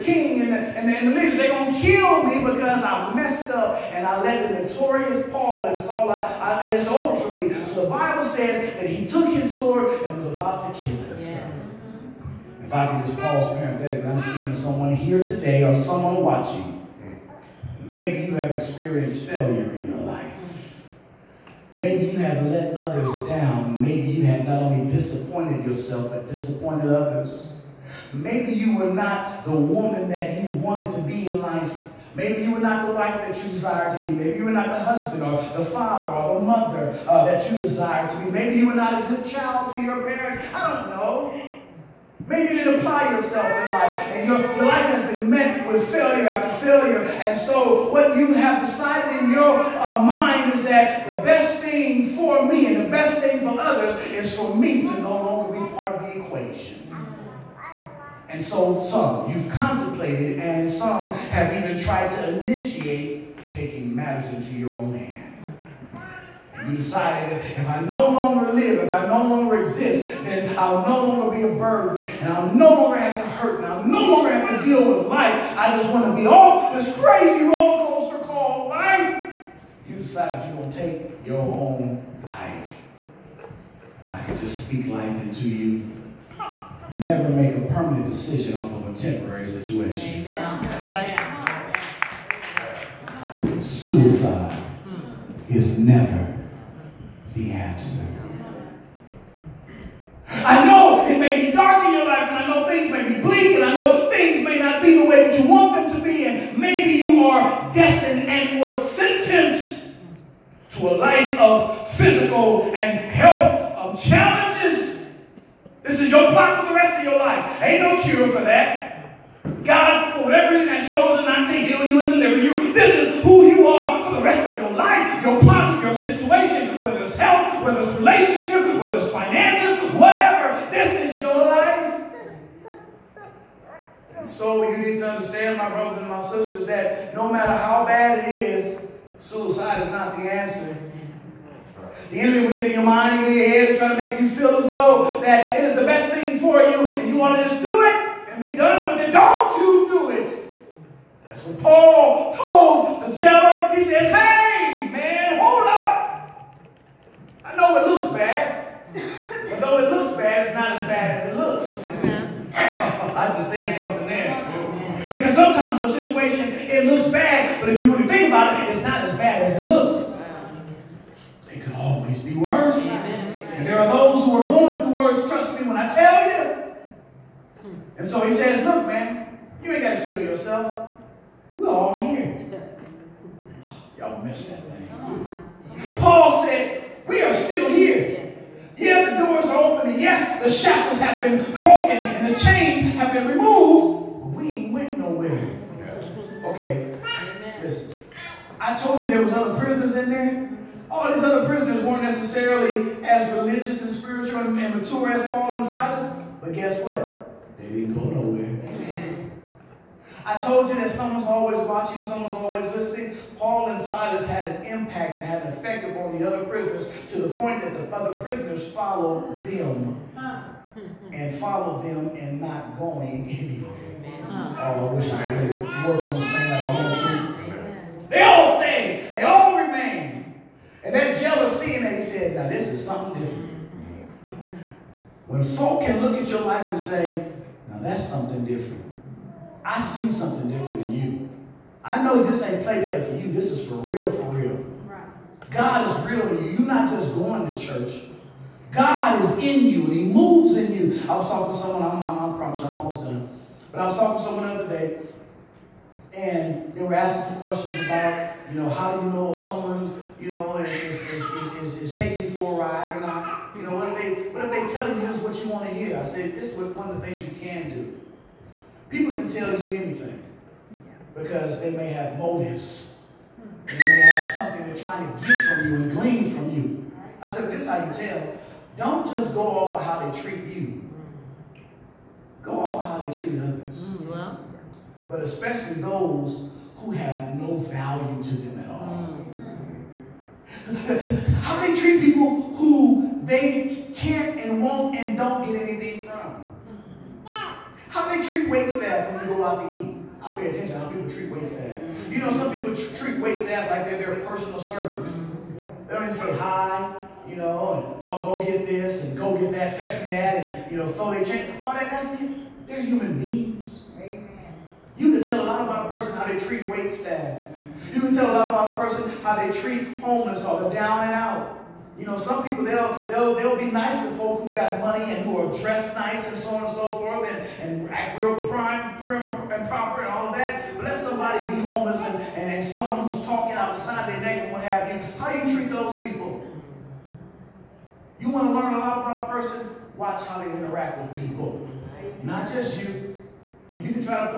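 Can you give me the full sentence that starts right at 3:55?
When folk can look at your life and say, now that's something different.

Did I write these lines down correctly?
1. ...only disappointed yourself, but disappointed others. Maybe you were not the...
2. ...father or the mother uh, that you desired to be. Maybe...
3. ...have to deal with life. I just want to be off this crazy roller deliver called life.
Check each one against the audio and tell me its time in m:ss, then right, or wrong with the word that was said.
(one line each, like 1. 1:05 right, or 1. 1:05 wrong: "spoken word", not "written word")
1. 0:24 right
2. 0:35 right
3. 1:14 wrong: "coaster", not "deliver".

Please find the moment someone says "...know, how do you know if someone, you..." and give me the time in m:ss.
4:18.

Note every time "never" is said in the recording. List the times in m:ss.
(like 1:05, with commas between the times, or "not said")
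1:26, 1:35.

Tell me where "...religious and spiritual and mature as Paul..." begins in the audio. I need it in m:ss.
3:23.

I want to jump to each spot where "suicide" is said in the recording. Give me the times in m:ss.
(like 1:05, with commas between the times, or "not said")
1:33, 2:19.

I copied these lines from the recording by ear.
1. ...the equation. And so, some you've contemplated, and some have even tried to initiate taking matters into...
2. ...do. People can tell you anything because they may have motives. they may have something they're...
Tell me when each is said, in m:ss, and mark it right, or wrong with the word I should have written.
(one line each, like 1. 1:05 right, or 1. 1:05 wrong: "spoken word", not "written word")
1. 0:56 right
2. 4:27 right.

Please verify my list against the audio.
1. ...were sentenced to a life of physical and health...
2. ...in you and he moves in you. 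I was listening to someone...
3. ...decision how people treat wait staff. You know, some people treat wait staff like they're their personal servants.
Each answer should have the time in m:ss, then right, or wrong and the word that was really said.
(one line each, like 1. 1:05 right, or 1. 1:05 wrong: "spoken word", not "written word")
1. 1:48 right
2. 4:09 wrong: "talking", not "listening"
3. 5:00 wrong: "attention", not "decision".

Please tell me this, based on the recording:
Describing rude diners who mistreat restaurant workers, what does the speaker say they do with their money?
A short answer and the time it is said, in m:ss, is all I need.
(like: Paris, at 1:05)
throw their change, at 5:10.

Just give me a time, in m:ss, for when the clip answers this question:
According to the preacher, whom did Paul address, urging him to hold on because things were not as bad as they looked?
2:33.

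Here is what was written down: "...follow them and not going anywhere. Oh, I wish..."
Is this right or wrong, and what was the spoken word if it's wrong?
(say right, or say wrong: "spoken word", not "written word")
right.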